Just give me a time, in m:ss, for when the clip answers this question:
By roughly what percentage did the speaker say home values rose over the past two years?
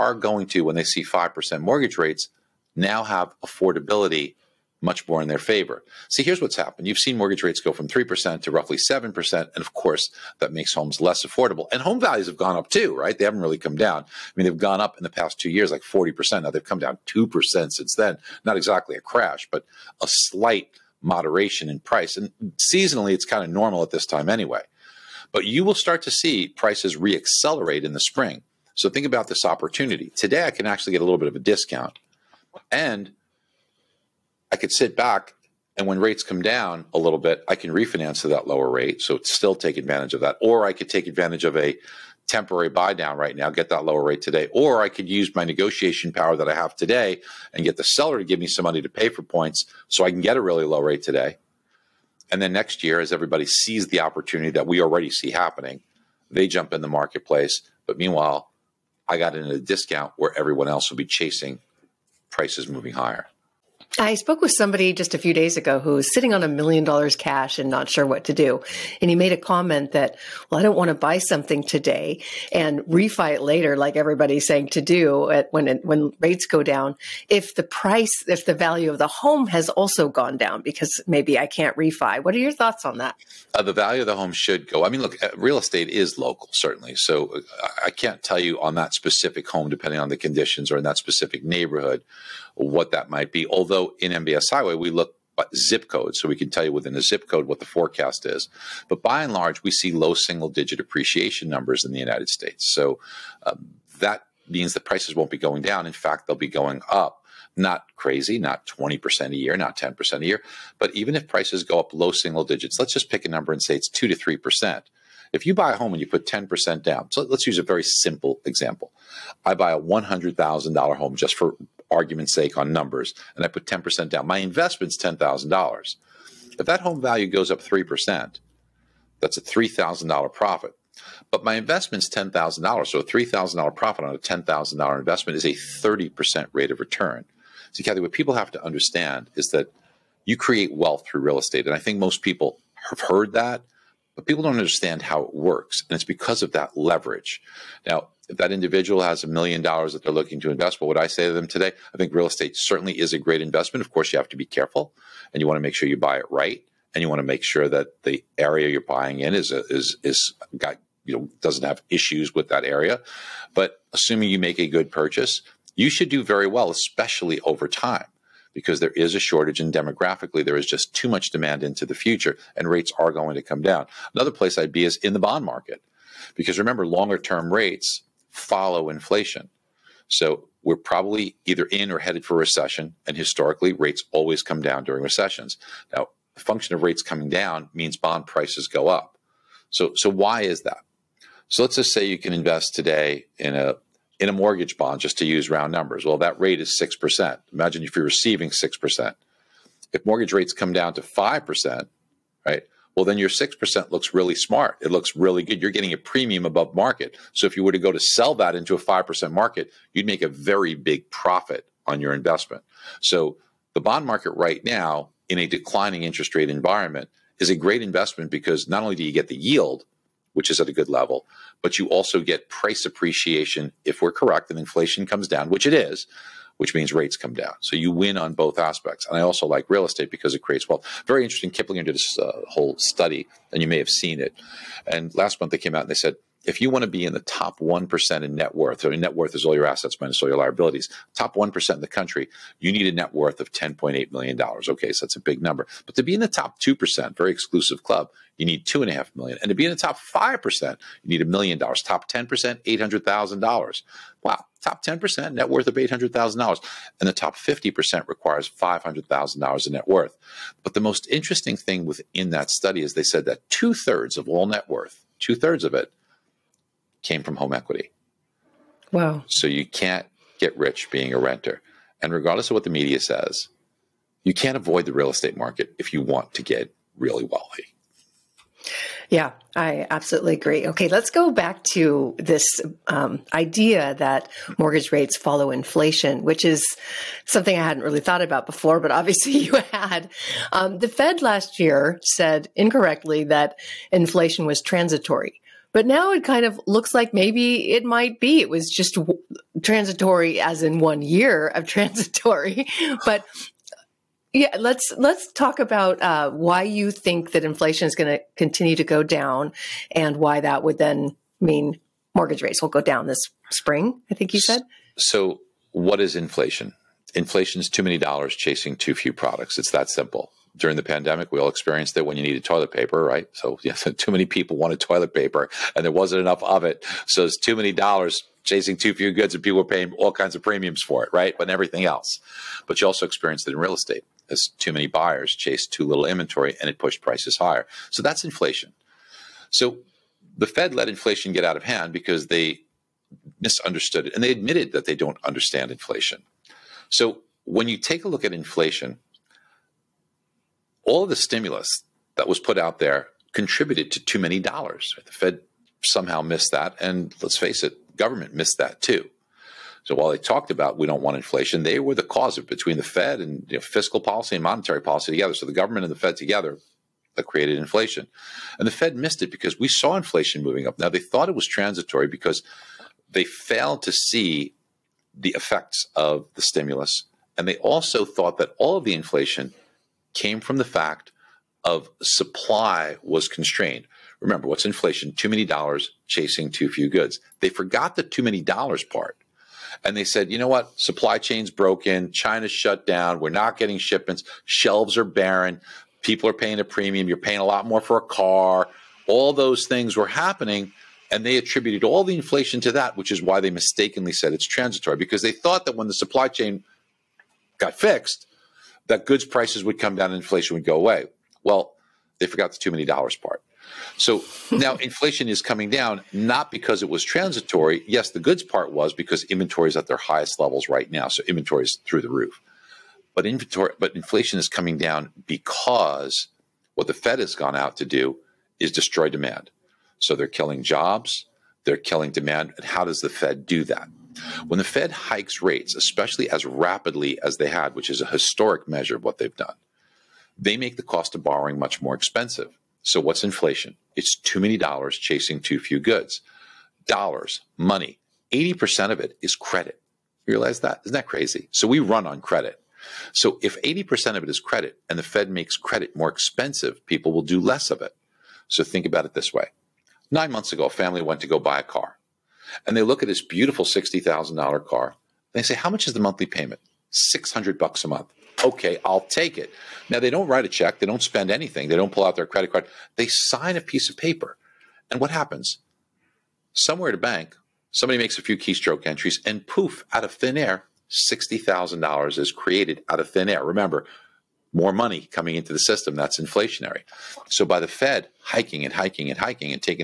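0:15.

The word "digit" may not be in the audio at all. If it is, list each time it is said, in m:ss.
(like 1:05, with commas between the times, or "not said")
1:40, 1:52.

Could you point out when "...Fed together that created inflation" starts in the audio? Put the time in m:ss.
6:05.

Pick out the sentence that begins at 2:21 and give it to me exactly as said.
And I think most people have heard that, but people don't understand how it works.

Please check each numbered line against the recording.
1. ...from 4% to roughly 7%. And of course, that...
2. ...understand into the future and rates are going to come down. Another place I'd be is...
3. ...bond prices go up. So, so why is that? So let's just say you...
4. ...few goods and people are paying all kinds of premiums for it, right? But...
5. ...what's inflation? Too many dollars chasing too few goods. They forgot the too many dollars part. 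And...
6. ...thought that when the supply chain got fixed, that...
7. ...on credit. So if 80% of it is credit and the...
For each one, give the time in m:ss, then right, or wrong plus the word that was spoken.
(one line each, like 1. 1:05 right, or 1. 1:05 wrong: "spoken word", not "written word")
1. 0:07 wrong: "3", not "4"
2. 2:51 wrong: "demand", not "understand"
3. 3:07 right
4. 5:28 right
5. 6:24 right
6. 6:45 right
7. 7:32 right.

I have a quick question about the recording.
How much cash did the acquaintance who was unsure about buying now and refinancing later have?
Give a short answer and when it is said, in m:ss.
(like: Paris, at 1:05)
$1 million, at 1:06.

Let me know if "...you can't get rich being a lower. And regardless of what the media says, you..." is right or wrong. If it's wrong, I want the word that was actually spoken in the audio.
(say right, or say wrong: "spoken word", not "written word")
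wrong: "renter", not "lower".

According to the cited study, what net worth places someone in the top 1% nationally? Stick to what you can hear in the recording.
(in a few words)
$10.8 million.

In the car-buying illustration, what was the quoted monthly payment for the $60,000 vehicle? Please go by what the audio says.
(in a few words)
$600.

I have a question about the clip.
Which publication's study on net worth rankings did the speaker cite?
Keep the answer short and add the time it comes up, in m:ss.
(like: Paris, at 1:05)
Kiplinger, at 3:51.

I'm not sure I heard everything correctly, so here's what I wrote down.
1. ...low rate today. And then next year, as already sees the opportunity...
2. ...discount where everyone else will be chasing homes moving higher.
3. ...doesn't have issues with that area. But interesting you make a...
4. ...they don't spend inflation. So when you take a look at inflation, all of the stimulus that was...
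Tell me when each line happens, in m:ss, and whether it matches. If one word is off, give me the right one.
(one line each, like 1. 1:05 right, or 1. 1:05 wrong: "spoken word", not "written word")
1. 0:50 wrong: "everybody", not "already"
2. 0:59 wrong: "prices", not "homes"
3. 2:41 wrong: "assuming", not "interesting"
4. 5:44 wrong: "understand", not "spend".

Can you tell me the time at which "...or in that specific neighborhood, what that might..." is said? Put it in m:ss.
1:30.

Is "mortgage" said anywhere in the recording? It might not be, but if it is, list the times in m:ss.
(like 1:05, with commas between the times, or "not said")
0:01, 0:07, 3:14, 3:20, 4:44, 5:12.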